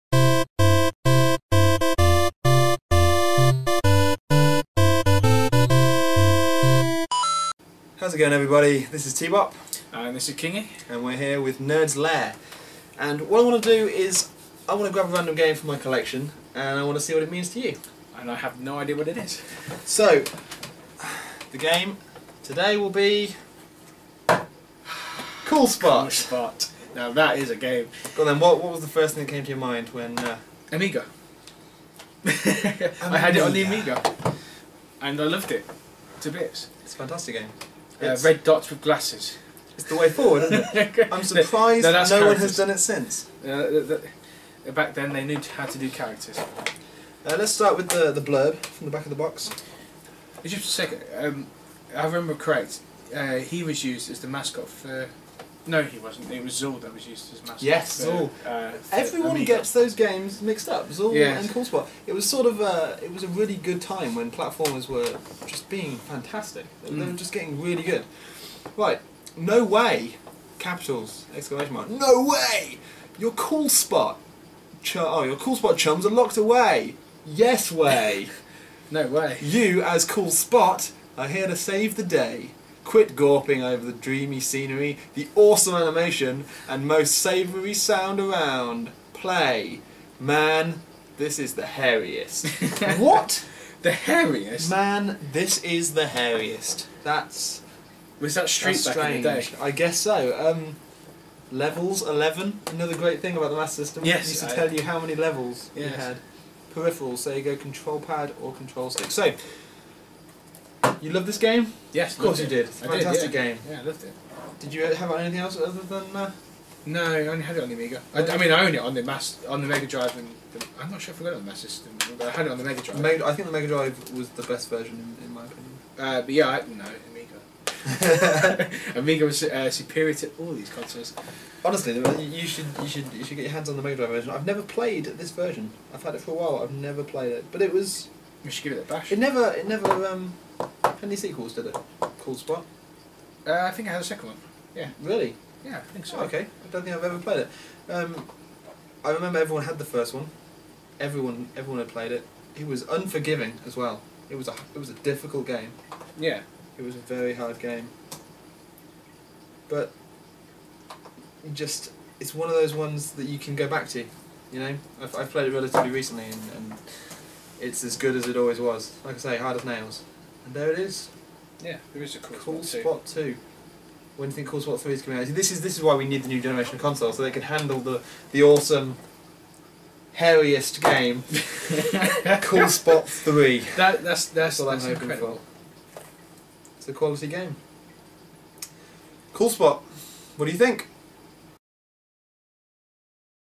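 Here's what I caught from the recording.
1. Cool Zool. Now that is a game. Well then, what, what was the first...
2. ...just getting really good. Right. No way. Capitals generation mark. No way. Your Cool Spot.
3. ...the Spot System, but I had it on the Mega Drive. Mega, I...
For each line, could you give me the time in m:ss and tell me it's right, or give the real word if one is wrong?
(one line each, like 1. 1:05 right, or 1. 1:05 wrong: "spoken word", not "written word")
1. 0:26 wrong: "Spot", not "Zool"
2. 1:07 wrong: "exclamation", not "generation"
3. 2:01 wrong: "Mass", not "Spot".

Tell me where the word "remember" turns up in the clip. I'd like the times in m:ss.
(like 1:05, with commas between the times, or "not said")
0:52, 2:29.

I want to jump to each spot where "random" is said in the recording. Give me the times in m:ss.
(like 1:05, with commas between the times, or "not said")
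0:15.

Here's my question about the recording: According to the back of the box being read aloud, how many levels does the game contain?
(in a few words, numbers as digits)
11.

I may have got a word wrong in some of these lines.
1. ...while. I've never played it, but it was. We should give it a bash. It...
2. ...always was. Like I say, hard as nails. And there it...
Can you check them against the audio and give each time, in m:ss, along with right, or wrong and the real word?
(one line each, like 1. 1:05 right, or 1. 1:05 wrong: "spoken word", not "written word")
1. 2:16 right
2. 2:48 right.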